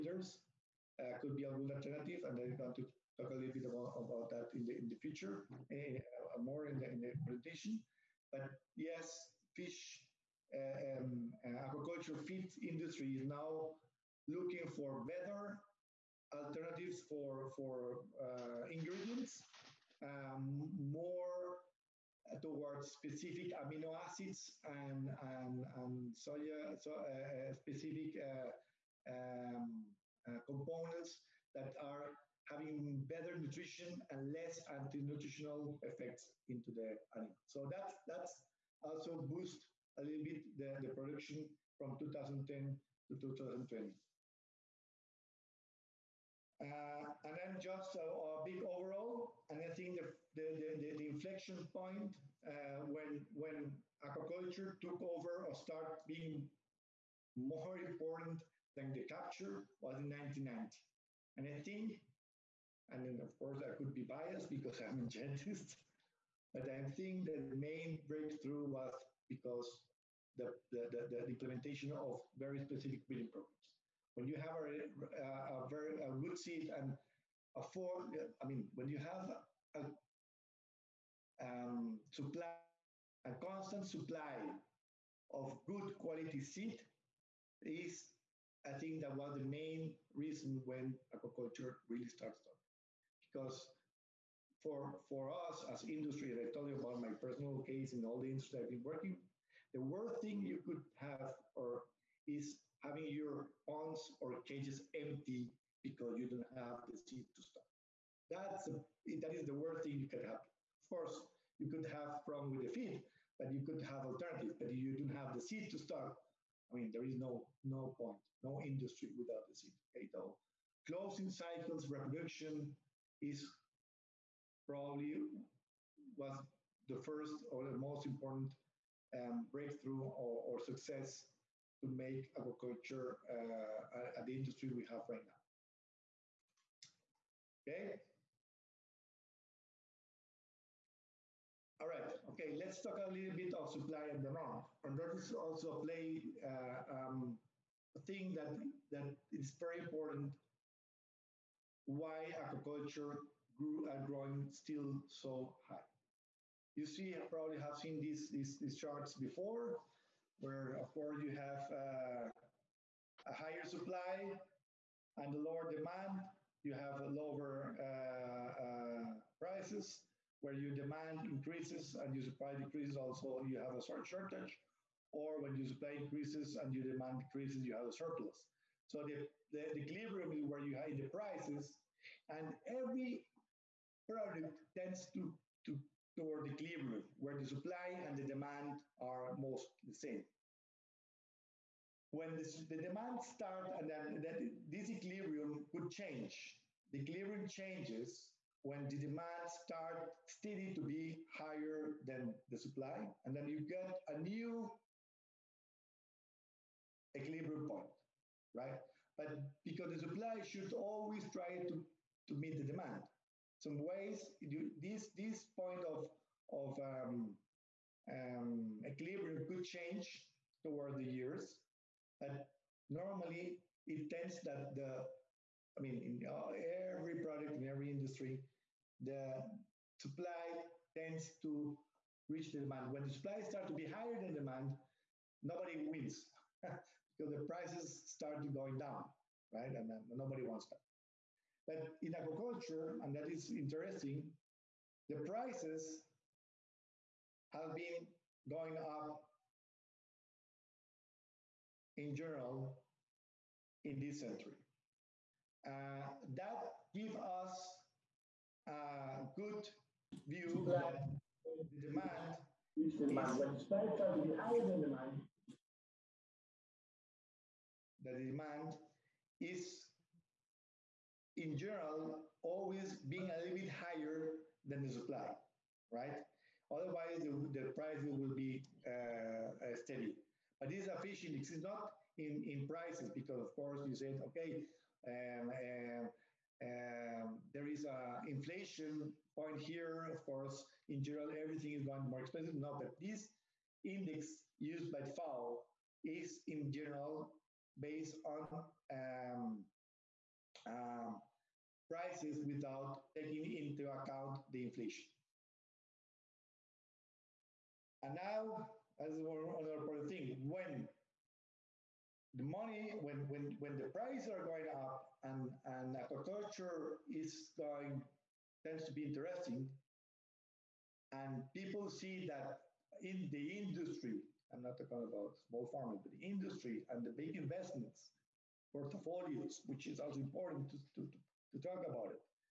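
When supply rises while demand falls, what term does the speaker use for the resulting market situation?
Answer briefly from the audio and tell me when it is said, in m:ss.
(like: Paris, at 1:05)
surplus, at 2:57.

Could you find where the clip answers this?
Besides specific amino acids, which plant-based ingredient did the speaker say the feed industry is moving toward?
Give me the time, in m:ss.
0:26.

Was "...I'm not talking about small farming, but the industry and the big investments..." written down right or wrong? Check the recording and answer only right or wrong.
right.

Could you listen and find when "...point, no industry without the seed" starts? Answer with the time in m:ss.
1:57.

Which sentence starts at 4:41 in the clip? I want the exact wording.
It's not in, in prices because, of course, you said, okay, um, um, um, there is a inflation point here.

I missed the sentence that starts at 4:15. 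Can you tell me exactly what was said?
Uh, that gives us a good view that the demand is demand.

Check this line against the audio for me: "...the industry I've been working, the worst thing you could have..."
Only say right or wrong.
right.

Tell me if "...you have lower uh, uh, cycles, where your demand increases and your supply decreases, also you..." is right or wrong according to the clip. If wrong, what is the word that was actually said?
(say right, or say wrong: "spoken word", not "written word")
wrong: "prices", not "cycles".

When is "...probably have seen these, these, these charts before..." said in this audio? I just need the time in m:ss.
2:37.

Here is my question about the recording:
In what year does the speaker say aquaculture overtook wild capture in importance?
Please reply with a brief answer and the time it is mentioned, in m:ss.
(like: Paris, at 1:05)
1990, at 1:00.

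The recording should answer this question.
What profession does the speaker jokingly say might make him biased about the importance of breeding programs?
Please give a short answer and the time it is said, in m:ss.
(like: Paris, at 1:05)
dentist, at 1:05.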